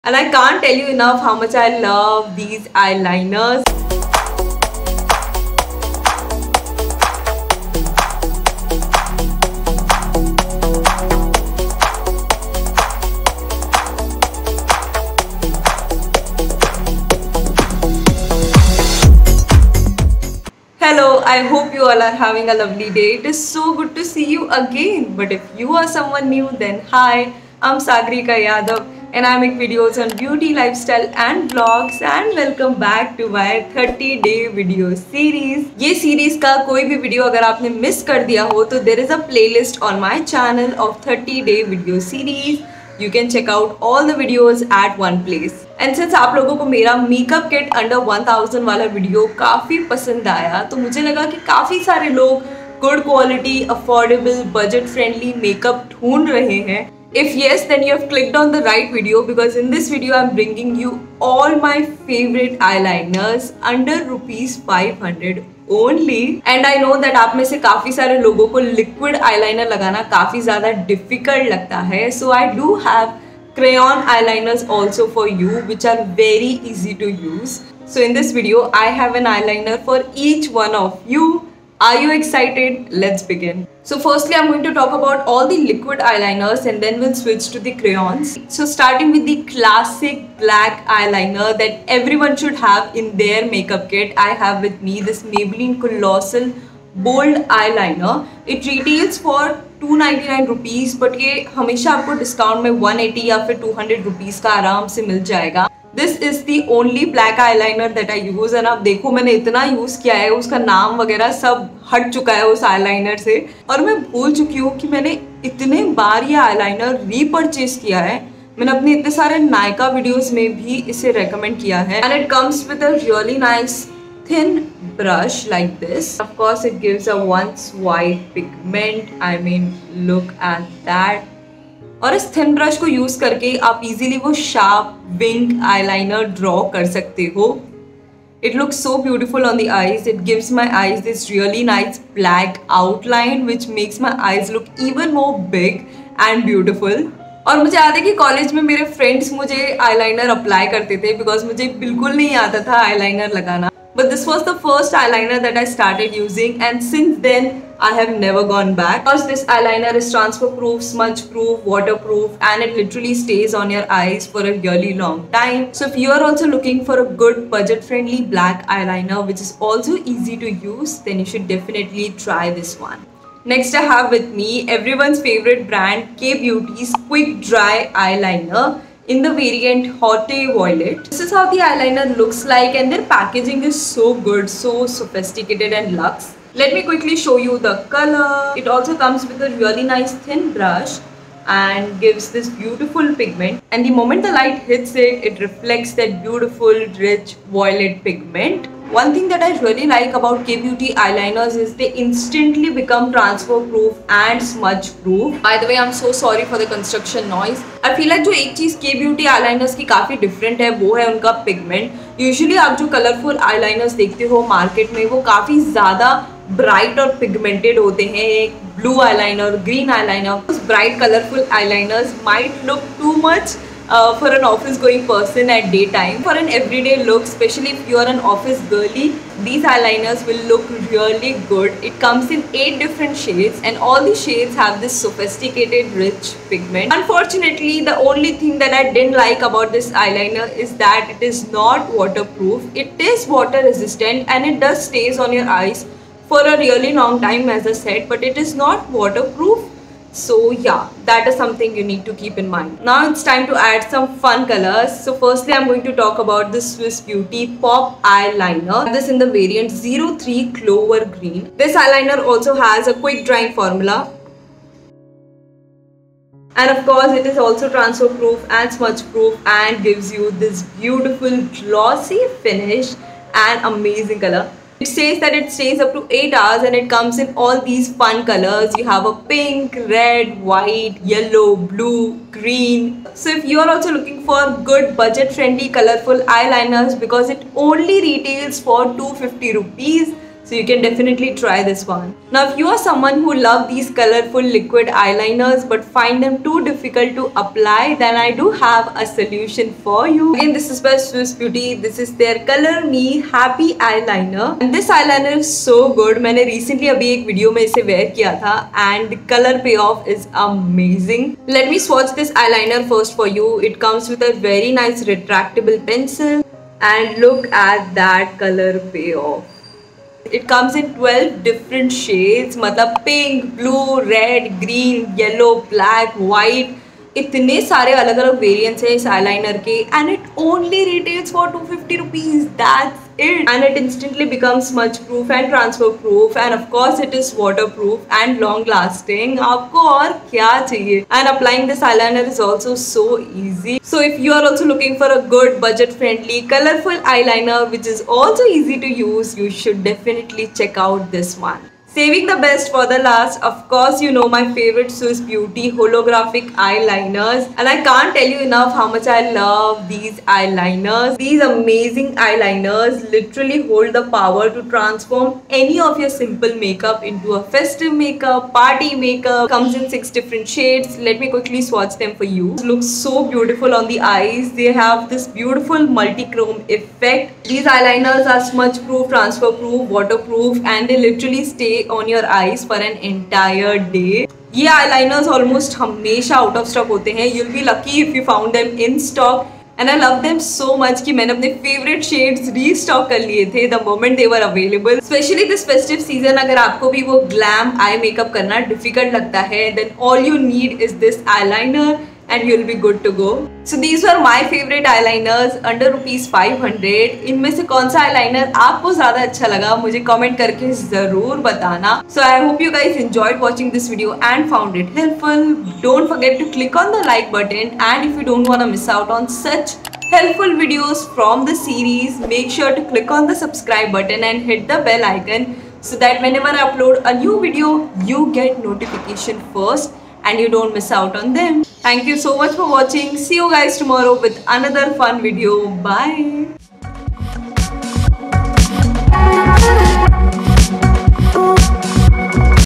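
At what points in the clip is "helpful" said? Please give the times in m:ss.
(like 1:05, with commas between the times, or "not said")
6:54, 7:00.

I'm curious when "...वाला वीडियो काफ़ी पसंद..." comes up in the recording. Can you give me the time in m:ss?
0:48.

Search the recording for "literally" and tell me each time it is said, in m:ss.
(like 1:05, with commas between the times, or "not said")
2:42, 6:03, 6:20.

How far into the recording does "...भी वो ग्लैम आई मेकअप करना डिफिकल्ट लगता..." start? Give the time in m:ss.
6:36.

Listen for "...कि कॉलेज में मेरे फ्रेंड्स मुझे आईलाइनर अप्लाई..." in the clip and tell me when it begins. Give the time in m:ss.
2:28.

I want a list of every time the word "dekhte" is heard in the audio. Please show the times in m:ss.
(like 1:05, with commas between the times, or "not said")
3:34.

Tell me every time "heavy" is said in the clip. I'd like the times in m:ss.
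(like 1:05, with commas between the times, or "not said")
not said.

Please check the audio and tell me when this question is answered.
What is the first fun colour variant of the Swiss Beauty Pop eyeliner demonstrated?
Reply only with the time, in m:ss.
4:19.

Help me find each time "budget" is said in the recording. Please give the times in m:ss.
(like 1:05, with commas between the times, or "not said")
2:47, 4:44, 5:45.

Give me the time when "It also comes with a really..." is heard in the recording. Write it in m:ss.
3:08.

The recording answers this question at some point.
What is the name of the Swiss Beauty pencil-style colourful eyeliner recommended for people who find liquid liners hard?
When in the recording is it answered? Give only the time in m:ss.
5:02.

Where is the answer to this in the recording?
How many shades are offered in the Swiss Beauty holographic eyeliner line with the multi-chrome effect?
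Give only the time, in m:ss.
6:09.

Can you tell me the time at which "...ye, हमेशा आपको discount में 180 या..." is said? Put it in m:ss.
1:41.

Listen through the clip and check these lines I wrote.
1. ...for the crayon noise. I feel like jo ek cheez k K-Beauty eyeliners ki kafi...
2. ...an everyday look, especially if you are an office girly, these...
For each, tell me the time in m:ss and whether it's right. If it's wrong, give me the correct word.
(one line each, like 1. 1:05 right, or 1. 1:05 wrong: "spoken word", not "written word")
1. 3:26 wrong: "construction", not "crayon"
2. 3:46 right.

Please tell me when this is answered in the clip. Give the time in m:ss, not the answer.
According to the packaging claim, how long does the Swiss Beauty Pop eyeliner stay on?
4:35.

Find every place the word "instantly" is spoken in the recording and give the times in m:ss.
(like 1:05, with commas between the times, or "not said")
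3:21, 5:33.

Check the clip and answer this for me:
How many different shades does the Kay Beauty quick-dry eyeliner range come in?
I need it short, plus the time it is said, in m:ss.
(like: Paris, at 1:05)
8, at 3:52.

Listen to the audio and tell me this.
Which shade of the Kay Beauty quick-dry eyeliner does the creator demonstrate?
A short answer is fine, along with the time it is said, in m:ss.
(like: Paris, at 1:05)
Haute Violet, at 2:59.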